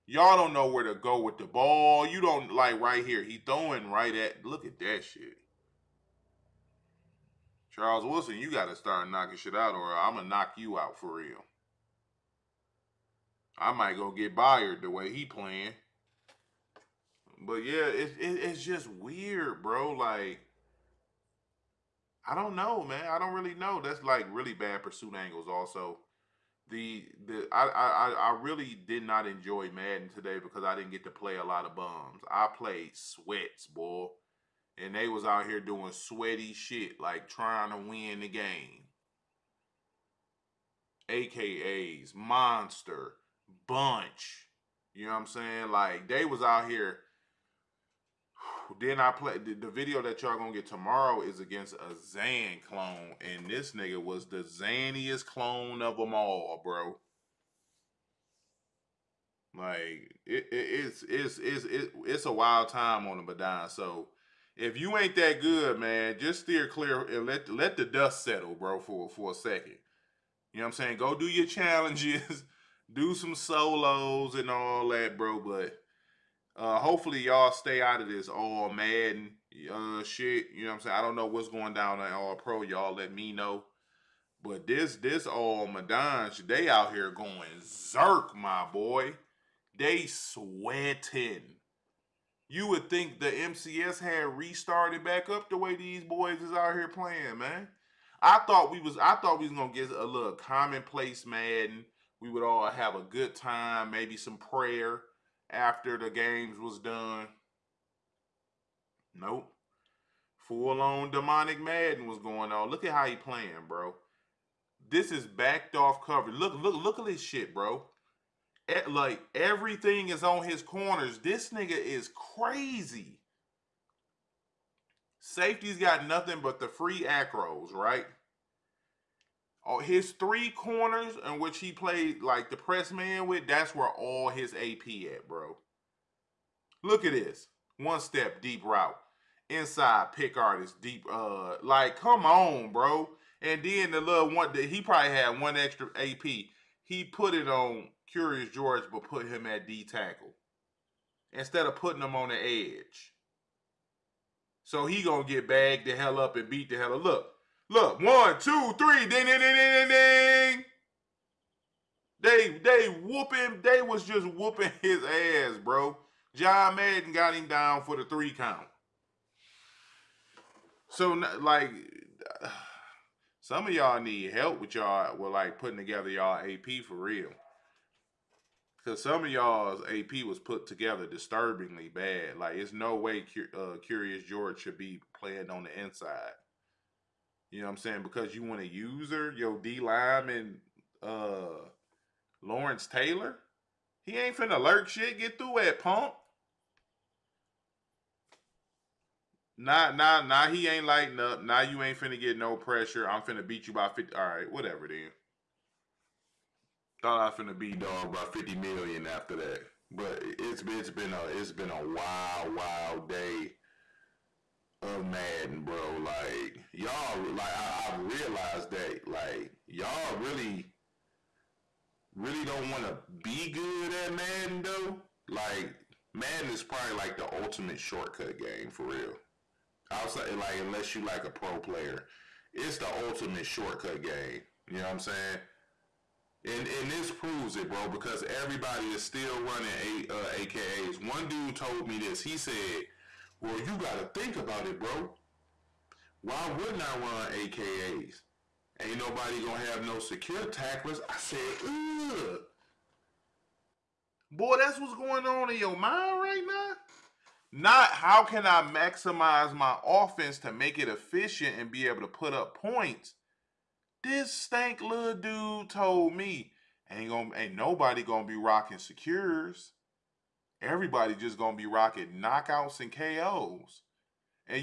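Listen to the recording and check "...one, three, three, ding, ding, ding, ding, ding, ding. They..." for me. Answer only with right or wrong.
wrong.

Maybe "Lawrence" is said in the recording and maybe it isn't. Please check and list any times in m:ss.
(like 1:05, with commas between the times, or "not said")
3:12.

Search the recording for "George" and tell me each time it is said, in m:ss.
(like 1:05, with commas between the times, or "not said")
2:28, 3:04.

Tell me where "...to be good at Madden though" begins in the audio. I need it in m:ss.
3:42.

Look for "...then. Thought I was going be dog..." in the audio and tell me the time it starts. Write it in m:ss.
3:24.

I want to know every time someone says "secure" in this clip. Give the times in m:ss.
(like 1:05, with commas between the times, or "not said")
4:09, 4:28.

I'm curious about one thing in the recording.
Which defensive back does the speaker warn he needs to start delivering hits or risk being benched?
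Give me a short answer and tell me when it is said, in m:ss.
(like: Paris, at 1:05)
Charles Woodson, at 0:07.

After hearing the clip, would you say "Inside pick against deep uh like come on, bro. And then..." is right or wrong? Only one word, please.
wrong.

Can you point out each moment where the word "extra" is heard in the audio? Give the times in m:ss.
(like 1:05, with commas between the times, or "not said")
2:25.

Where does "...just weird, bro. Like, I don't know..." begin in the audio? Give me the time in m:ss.
0:18.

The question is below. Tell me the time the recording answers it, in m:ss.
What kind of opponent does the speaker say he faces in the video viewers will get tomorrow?
0:52.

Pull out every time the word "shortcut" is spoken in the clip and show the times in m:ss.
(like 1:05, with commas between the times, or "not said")
3:47, 3:53.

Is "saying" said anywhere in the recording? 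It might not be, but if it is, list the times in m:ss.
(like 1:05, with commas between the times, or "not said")
0:45, 1:10, 1:20, 3:07, 3:54.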